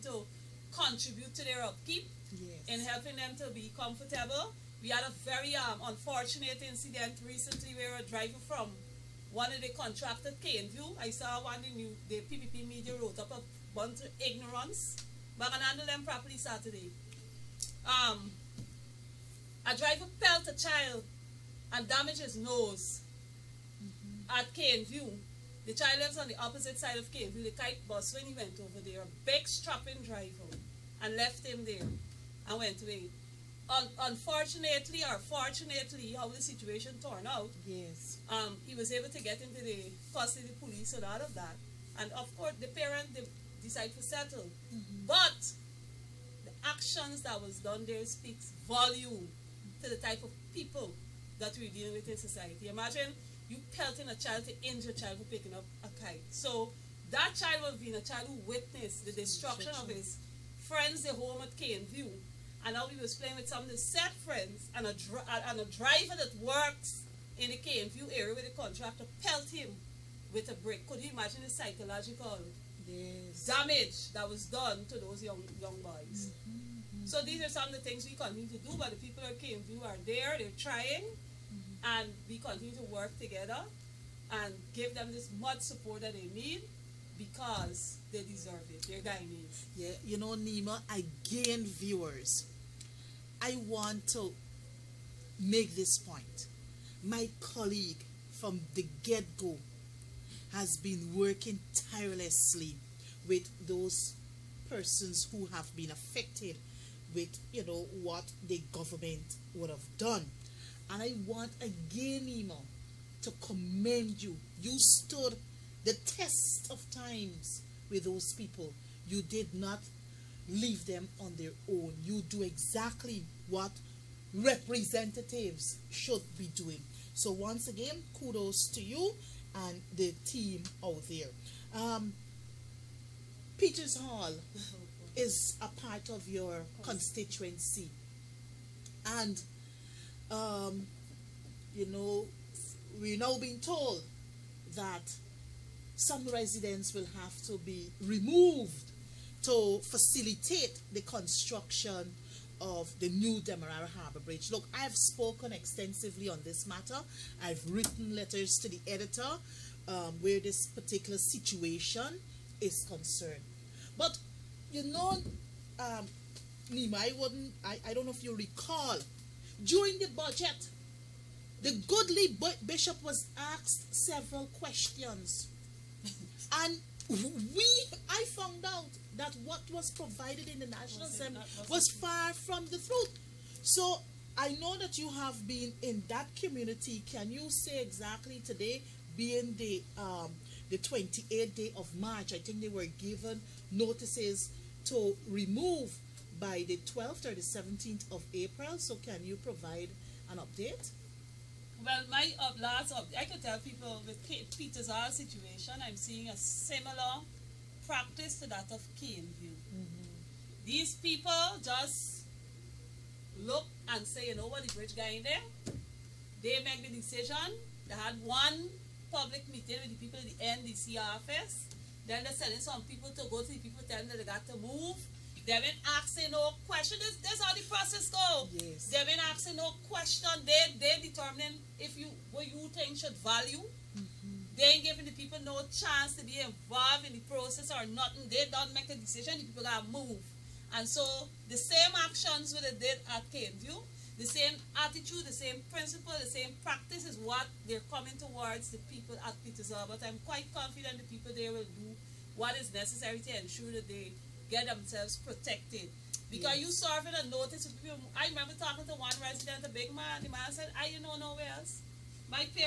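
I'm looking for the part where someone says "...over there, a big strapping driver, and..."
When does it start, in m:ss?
0:28.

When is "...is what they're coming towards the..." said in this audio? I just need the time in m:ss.
4:07.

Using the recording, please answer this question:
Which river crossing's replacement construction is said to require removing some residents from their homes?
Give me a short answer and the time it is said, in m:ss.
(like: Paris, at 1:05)
Demerara Harbour Bridge, at 2:33.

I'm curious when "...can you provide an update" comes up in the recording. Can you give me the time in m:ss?
3:18.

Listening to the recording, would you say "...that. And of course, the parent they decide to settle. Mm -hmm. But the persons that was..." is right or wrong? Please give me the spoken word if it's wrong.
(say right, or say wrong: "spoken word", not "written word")
wrong: "actions", not "persons".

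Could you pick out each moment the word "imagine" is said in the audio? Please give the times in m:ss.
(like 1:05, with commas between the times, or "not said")
0:52, 1:11.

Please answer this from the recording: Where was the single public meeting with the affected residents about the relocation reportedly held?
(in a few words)
The NDC office.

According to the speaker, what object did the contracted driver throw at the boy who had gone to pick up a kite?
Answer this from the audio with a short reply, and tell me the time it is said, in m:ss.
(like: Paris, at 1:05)
A brick, at 1:10.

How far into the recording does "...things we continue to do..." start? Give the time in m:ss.
1:17.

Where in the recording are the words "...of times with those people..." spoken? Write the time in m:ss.
1:56.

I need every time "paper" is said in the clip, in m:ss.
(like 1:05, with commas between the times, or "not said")
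not said.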